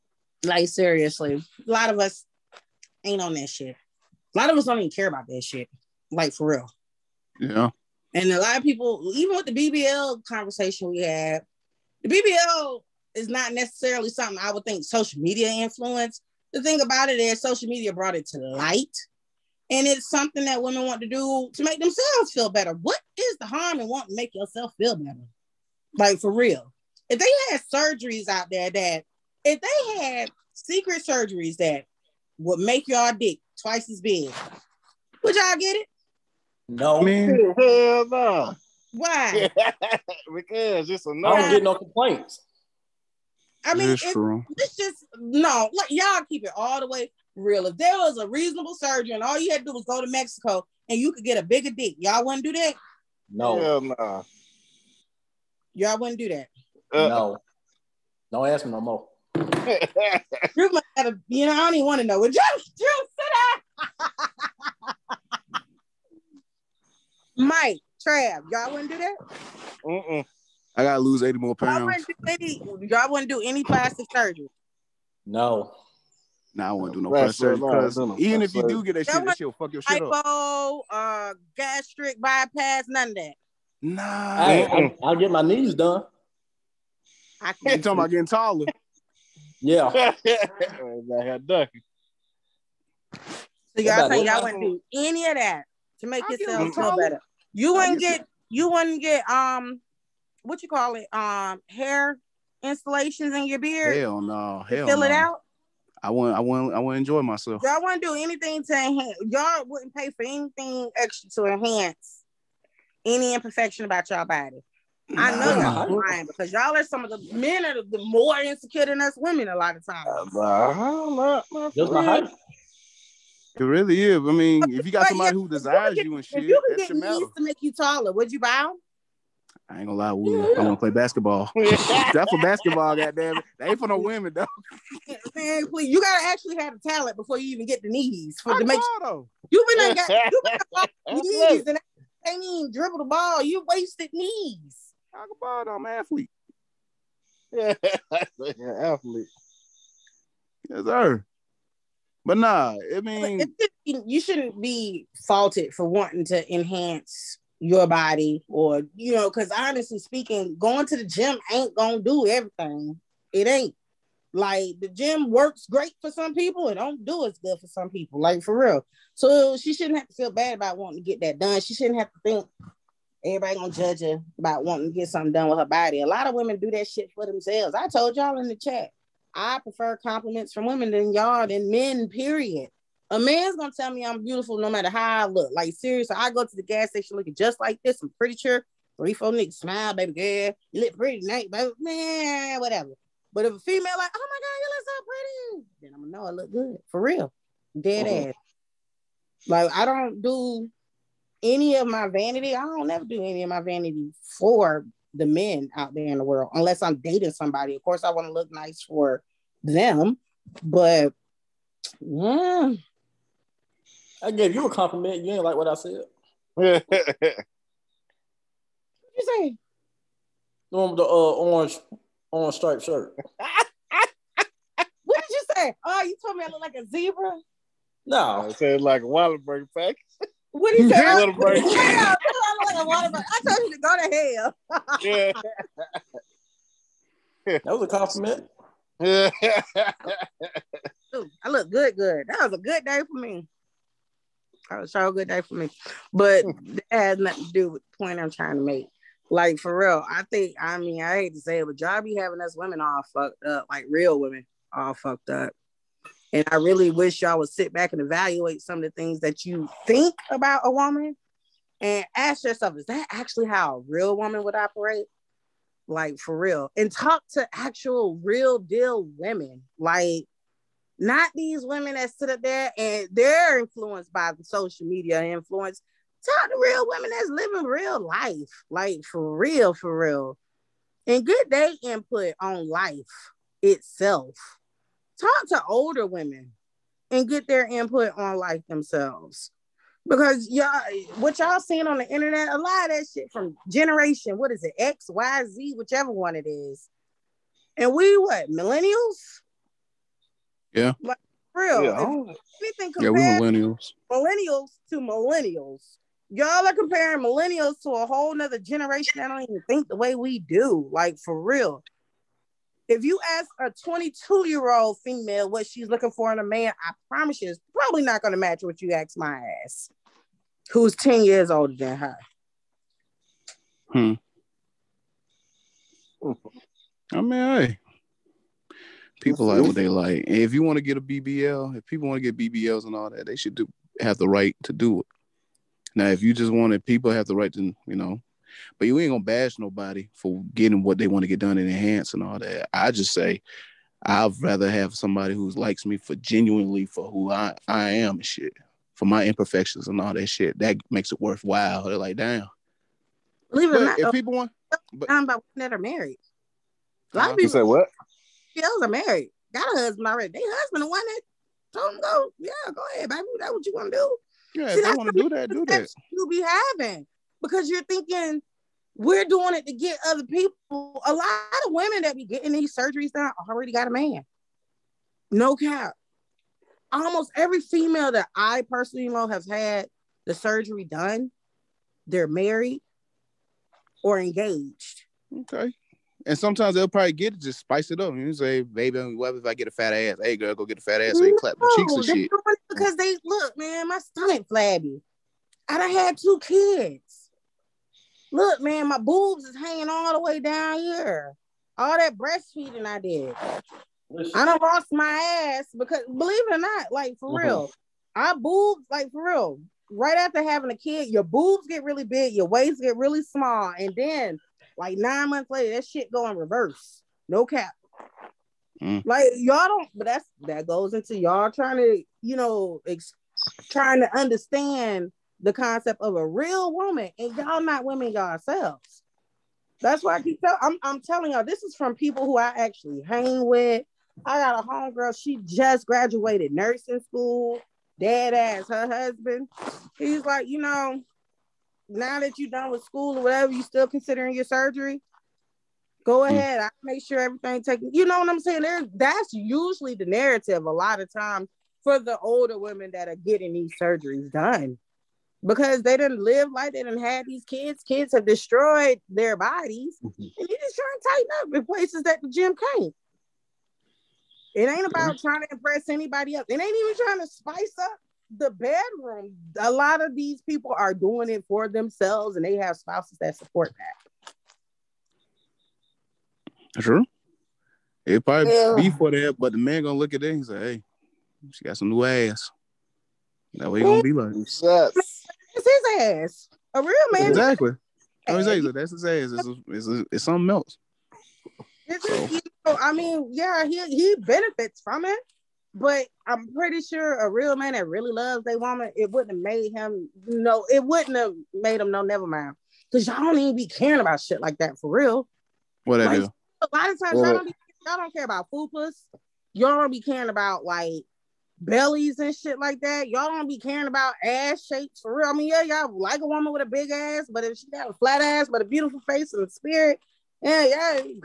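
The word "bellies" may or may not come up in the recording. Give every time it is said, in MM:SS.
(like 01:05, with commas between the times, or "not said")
08:31.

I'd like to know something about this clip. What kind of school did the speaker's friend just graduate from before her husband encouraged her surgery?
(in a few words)
nursing school.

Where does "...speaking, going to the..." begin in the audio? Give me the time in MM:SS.
02:39.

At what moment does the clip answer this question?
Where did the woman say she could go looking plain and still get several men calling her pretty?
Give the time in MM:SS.
03:06.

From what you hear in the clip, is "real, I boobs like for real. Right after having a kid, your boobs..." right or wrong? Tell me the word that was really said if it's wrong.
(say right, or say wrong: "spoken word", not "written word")
right.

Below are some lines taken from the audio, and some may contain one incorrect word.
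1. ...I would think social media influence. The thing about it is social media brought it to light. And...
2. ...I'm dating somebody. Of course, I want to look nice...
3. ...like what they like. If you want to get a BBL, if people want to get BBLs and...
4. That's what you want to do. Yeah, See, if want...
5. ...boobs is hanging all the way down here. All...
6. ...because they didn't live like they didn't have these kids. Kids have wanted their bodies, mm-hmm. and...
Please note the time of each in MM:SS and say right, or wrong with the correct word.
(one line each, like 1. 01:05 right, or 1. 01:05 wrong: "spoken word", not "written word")
1. 00:14 right
2. 03:26 right
3. 05:29 right
4. 06:03 right
5. 06:38 right
6. 07:35 wrong: "destroyed", not "wanted".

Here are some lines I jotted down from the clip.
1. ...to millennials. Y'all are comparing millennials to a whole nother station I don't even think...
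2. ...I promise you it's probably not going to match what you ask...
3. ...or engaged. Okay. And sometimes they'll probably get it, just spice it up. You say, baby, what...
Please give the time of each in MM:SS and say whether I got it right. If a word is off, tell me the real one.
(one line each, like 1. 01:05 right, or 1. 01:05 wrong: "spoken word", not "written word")
1. 05:04 wrong: "generation", not "station"
2. 05:16 right
3. 06:24 right.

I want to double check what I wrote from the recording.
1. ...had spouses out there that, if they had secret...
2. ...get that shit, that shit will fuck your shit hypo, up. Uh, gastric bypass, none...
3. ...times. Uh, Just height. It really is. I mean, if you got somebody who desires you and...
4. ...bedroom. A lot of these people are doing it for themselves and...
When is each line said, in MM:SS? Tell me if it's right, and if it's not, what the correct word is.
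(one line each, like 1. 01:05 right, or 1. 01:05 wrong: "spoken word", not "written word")
1. 00:27 wrong: "surgeries", not "spouses"
2. 01:18 right
3. 01:59 right
4. 07:48 right.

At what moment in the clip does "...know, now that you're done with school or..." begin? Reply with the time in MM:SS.
07:20.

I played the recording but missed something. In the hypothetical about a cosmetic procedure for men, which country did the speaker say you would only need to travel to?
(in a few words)
Mexico.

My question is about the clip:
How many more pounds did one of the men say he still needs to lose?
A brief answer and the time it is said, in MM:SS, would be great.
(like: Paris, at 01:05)
80, at 01:11.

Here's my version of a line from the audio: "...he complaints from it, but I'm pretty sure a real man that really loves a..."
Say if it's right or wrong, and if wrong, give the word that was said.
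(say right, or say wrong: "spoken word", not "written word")
wrong: "benefits", not "complaints".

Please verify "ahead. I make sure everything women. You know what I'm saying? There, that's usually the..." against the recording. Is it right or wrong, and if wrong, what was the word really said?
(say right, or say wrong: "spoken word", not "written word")
wrong: "taken", not "women".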